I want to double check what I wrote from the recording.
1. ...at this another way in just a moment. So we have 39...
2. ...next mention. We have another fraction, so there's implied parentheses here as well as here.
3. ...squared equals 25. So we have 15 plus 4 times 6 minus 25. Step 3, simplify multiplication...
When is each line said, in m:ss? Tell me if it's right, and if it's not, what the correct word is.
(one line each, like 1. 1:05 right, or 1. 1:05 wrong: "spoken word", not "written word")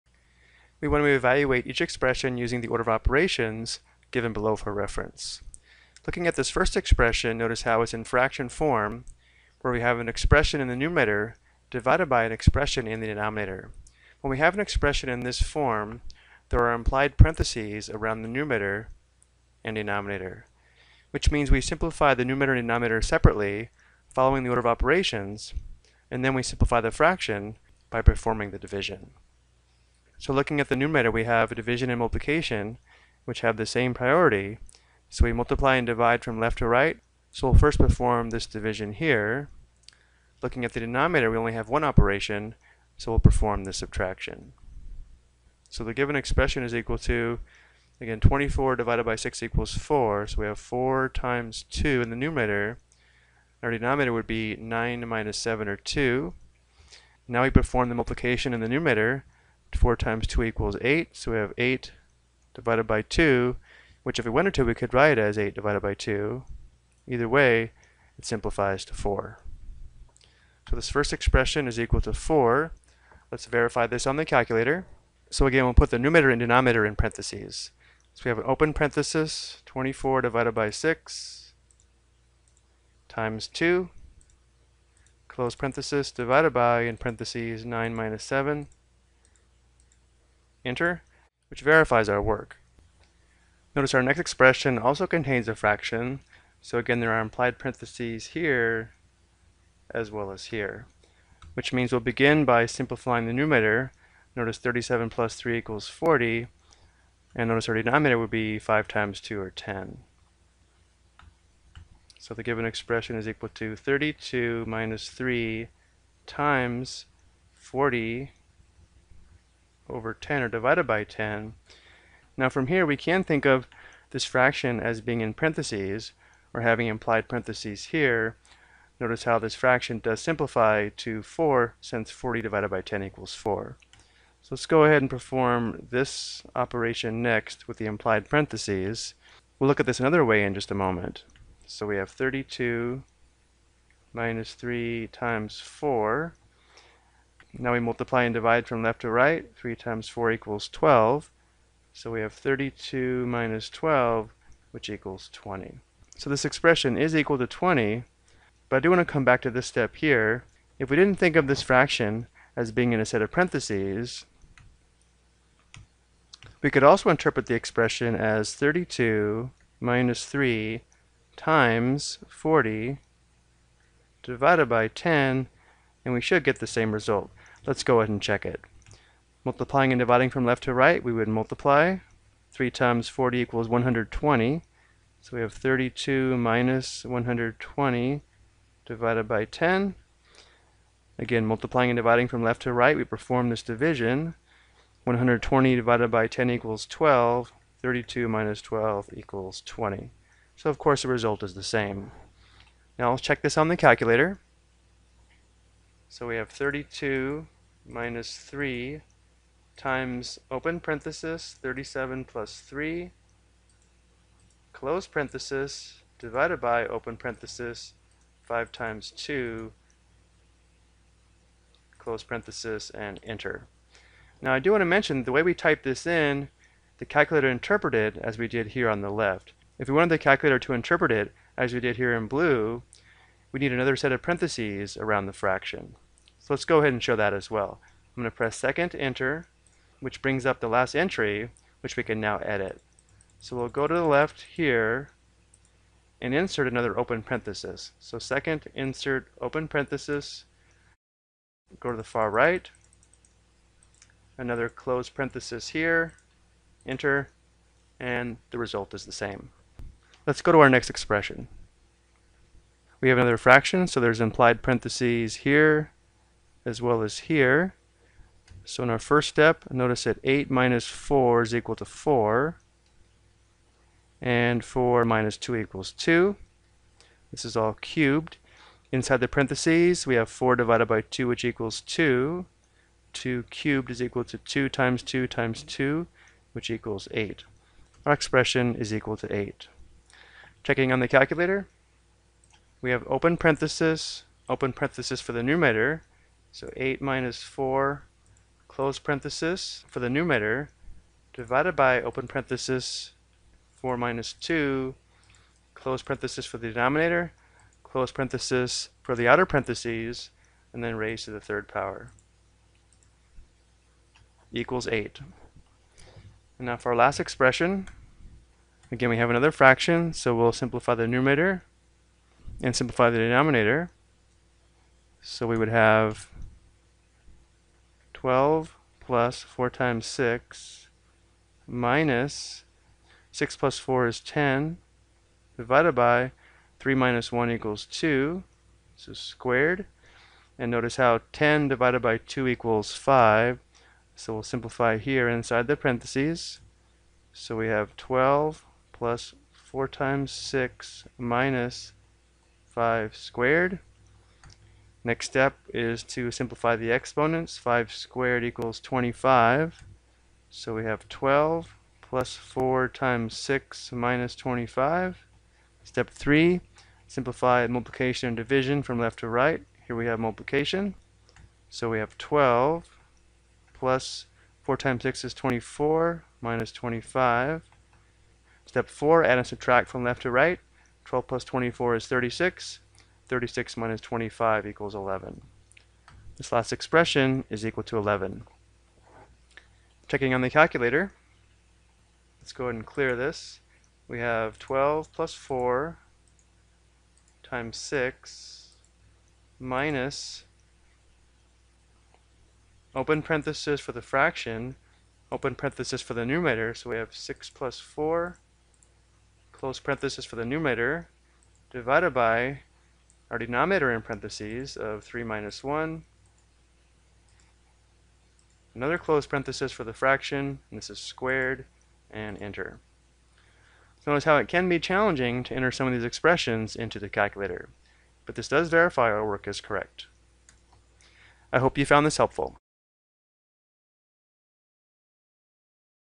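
1. 2:19 wrong: "32", not "39"
2. 4:20 wrong: "expression", not "mention"
3. 5:57 wrong: "12", not "15".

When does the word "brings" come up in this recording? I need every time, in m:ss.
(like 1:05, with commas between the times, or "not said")
4:00.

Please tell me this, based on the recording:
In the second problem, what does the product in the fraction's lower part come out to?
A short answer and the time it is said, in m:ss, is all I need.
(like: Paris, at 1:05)
10, at 1:48.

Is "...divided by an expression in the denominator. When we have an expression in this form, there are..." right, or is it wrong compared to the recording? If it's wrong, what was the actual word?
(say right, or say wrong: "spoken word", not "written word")
right.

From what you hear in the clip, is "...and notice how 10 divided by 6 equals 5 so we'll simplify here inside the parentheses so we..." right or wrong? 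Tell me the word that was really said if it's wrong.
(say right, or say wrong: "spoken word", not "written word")
wrong: "2", not "6".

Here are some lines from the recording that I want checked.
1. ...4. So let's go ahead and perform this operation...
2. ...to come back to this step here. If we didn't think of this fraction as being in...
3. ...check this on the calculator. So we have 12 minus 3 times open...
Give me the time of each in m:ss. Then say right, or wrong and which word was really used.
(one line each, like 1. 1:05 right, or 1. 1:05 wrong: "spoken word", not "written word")
1. 2:13 right
2. 2:39 right
3. 3:23 wrong: "32", not "12".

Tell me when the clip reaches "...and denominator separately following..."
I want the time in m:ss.
0:22.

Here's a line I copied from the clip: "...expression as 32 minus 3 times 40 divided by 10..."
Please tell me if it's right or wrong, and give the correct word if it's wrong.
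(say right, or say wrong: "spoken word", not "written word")
right.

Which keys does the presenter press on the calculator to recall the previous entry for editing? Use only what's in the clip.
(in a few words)
second enter.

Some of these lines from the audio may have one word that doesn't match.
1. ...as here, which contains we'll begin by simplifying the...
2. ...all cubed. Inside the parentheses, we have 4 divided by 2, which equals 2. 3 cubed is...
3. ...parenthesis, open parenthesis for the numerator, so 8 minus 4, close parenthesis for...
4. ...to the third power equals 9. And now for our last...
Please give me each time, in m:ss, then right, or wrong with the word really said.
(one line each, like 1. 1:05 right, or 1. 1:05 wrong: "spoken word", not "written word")
1. 1:40 wrong: "means", not "contains"
2. 4:37 wrong: "2", not "3"
3. 4:53 right
4. 5:11 wrong: "8", not "9".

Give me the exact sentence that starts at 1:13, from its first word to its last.
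Let's verify this on the calculator.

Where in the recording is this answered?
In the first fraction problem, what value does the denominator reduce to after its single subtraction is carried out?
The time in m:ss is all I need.
0:54.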